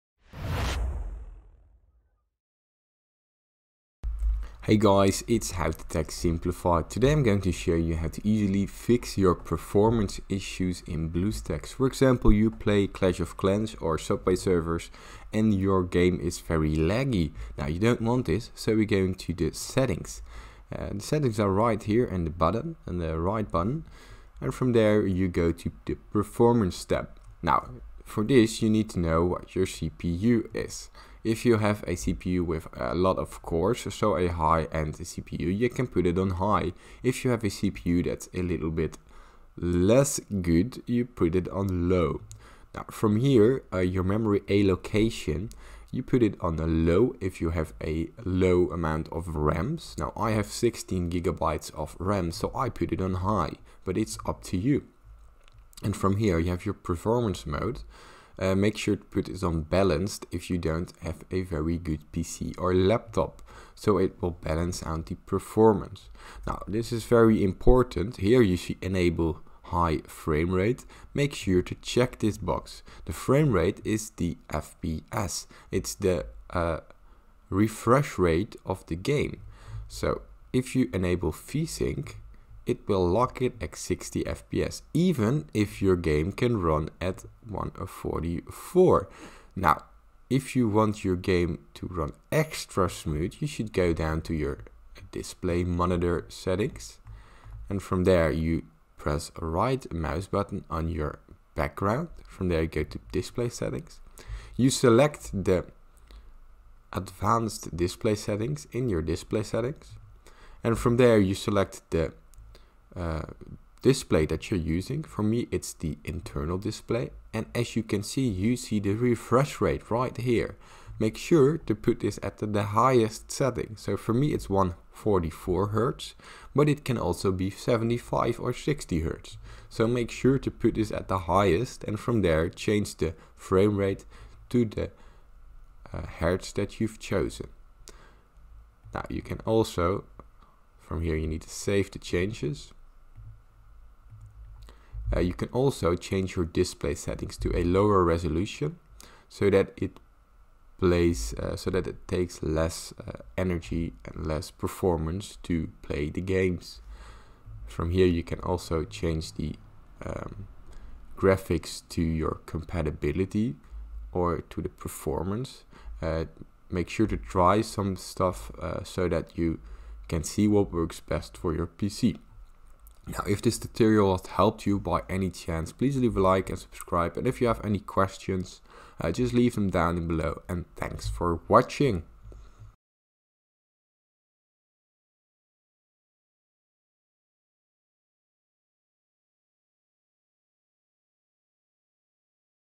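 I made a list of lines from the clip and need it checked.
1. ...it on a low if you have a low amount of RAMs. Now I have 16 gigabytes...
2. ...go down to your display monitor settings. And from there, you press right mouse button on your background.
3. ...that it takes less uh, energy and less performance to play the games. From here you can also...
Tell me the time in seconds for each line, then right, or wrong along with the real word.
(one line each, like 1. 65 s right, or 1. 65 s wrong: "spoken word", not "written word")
1. 46 s right
2. 93 s right
3. 151 s right.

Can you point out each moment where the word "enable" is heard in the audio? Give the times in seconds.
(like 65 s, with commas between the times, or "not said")
68 s, 80 s.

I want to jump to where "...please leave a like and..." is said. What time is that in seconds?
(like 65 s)
175 s.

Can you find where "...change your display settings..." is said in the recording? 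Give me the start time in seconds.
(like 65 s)
145 s.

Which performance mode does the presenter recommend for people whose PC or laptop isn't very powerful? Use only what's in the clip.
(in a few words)
Balanced.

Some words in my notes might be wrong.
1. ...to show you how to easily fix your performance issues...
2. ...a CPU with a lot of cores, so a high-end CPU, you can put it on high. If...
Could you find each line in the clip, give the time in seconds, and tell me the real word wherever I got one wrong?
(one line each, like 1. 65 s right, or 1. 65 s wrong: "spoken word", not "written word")
1. 7 s right
2. 31 s right.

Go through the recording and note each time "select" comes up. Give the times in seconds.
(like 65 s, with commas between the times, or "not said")
104 s, 111 s.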